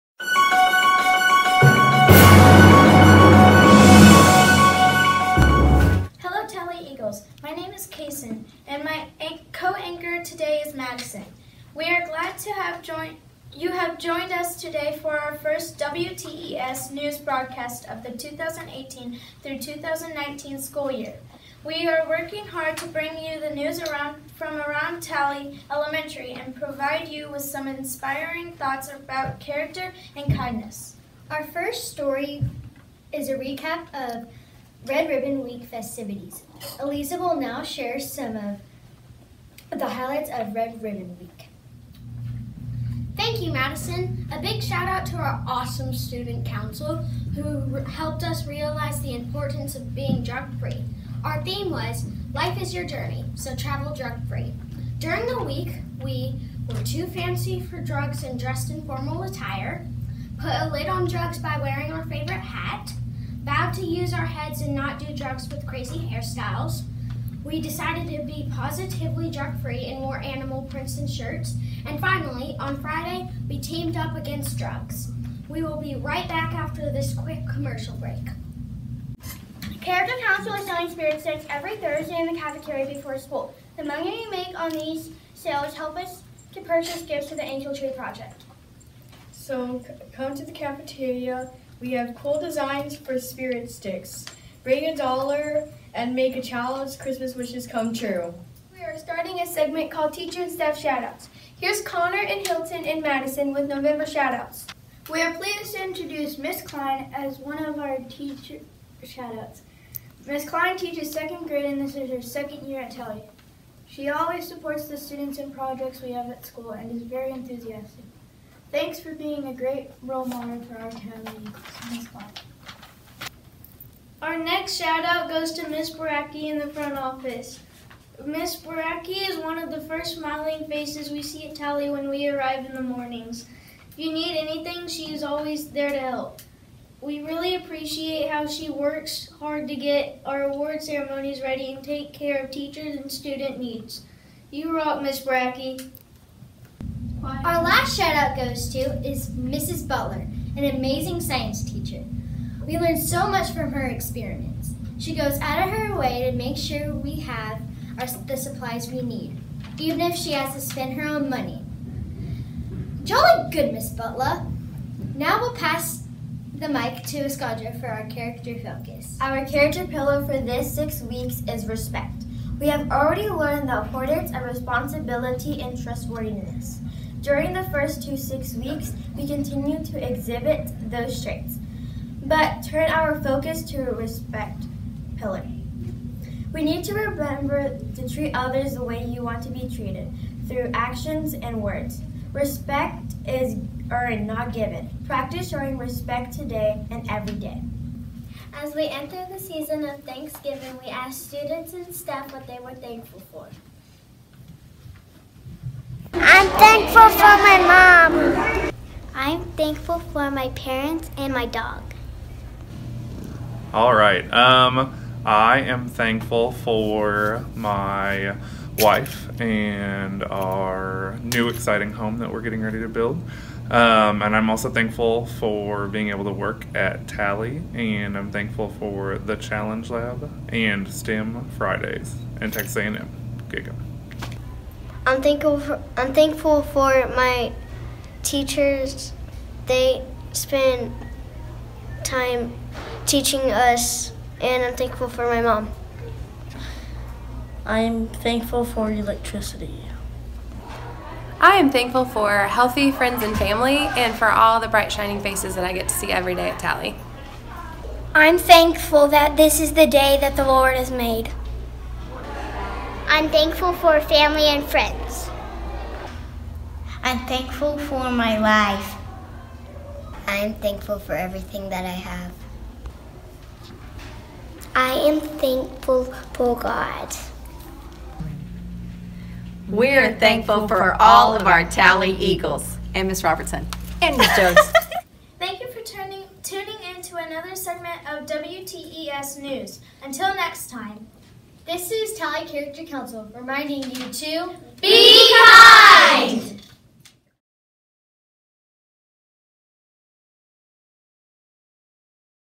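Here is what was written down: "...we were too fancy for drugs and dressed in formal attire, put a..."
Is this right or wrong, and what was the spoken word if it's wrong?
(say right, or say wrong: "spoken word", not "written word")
right.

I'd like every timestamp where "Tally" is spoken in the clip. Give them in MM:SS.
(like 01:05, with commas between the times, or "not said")
00:25, 01:52, 02:11, 03:47, 04:16, 04:41, 04:52.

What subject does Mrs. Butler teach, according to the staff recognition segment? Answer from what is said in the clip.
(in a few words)
Science.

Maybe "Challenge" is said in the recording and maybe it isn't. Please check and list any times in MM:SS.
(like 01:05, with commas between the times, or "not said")
03:49.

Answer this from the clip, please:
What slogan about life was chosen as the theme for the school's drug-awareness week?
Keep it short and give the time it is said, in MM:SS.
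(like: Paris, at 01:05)
Life is Your Journey, at 00:52.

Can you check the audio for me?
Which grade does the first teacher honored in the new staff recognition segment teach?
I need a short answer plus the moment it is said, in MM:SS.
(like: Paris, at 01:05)
Second grade, at 01:51.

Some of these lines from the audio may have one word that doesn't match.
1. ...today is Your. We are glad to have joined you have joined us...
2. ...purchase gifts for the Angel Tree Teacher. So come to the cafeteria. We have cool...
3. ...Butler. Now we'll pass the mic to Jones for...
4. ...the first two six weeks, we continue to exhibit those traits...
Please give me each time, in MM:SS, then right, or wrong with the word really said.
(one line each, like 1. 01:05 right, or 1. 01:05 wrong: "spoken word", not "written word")
1. 00:10 wrong: "Madison", not "Your"
2. 01:26 wrong: "Project", not "Teacher"
3. 02:43 wrong: "Escadra", not "Jones"
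4. 02:57 right.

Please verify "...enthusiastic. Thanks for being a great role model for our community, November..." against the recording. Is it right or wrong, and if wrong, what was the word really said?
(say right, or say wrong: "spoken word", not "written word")
wrong: "Miss", not "November".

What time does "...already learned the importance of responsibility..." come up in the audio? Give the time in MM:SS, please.
02:52.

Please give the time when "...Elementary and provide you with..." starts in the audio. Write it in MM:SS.
00:25.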